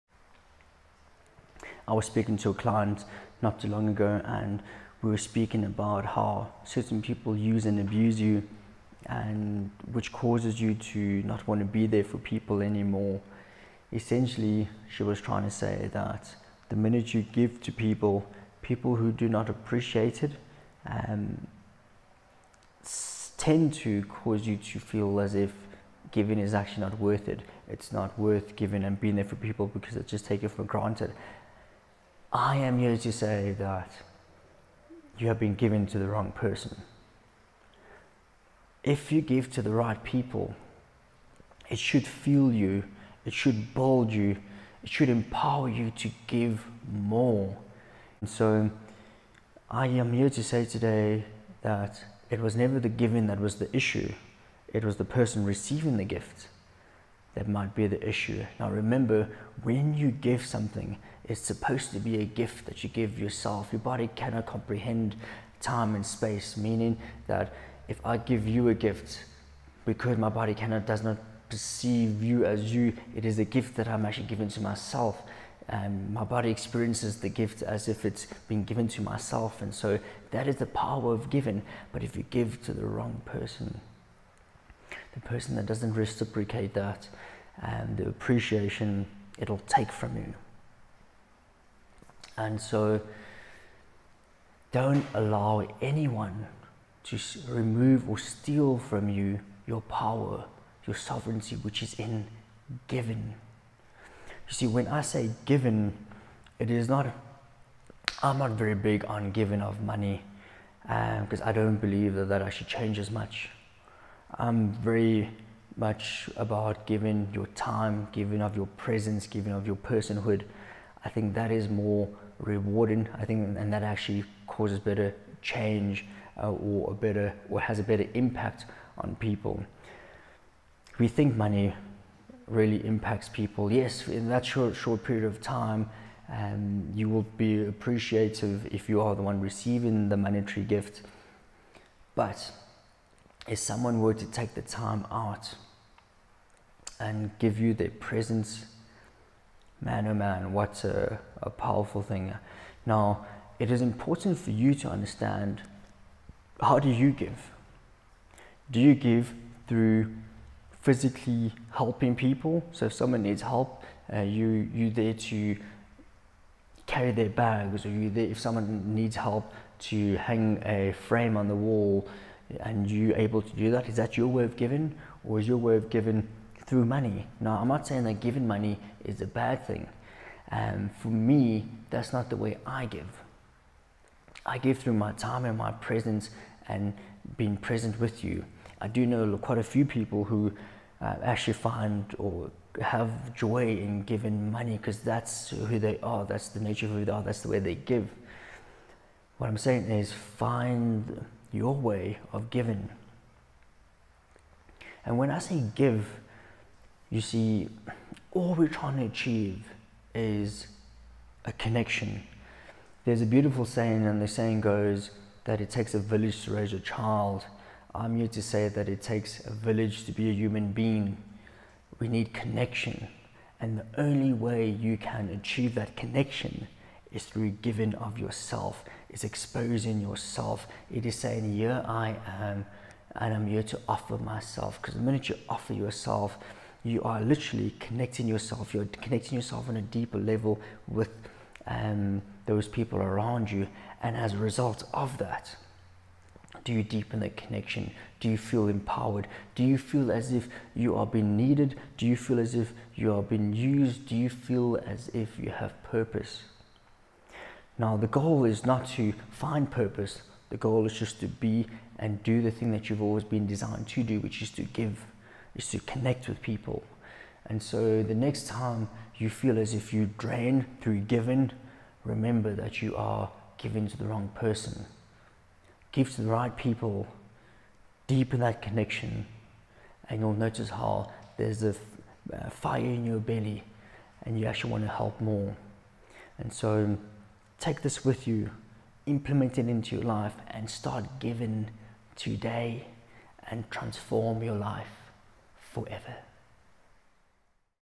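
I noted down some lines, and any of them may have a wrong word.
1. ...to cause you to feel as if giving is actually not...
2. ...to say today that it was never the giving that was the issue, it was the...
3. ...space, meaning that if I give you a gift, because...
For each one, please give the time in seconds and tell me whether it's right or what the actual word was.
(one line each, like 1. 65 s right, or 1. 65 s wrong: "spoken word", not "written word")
1. 23 s right
2. 50 s right
3. 66 s right.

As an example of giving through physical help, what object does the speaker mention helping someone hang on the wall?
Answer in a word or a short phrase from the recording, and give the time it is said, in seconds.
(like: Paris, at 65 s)
a frame, at 170 s.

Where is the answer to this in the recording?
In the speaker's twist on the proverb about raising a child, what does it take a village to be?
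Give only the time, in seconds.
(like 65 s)
220 s.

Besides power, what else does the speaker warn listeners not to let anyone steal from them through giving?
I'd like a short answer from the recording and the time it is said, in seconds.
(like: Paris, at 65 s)
sovereignty, at 100 s.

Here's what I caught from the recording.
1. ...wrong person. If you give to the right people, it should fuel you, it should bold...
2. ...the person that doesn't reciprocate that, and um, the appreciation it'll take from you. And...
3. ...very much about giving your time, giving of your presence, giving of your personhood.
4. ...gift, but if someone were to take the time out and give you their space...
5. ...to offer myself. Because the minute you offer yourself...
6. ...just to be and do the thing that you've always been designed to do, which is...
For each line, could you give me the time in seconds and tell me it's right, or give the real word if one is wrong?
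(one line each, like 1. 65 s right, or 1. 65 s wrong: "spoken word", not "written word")
1. 36 s right
2. 85 s right
3. 114 s right
4. 140 s wrong: "presence", not "space"
5. 233 s right
6. 260 s right.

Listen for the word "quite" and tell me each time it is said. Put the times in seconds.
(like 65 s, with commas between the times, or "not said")
189 s.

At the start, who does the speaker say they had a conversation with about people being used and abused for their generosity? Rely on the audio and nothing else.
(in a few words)
a client.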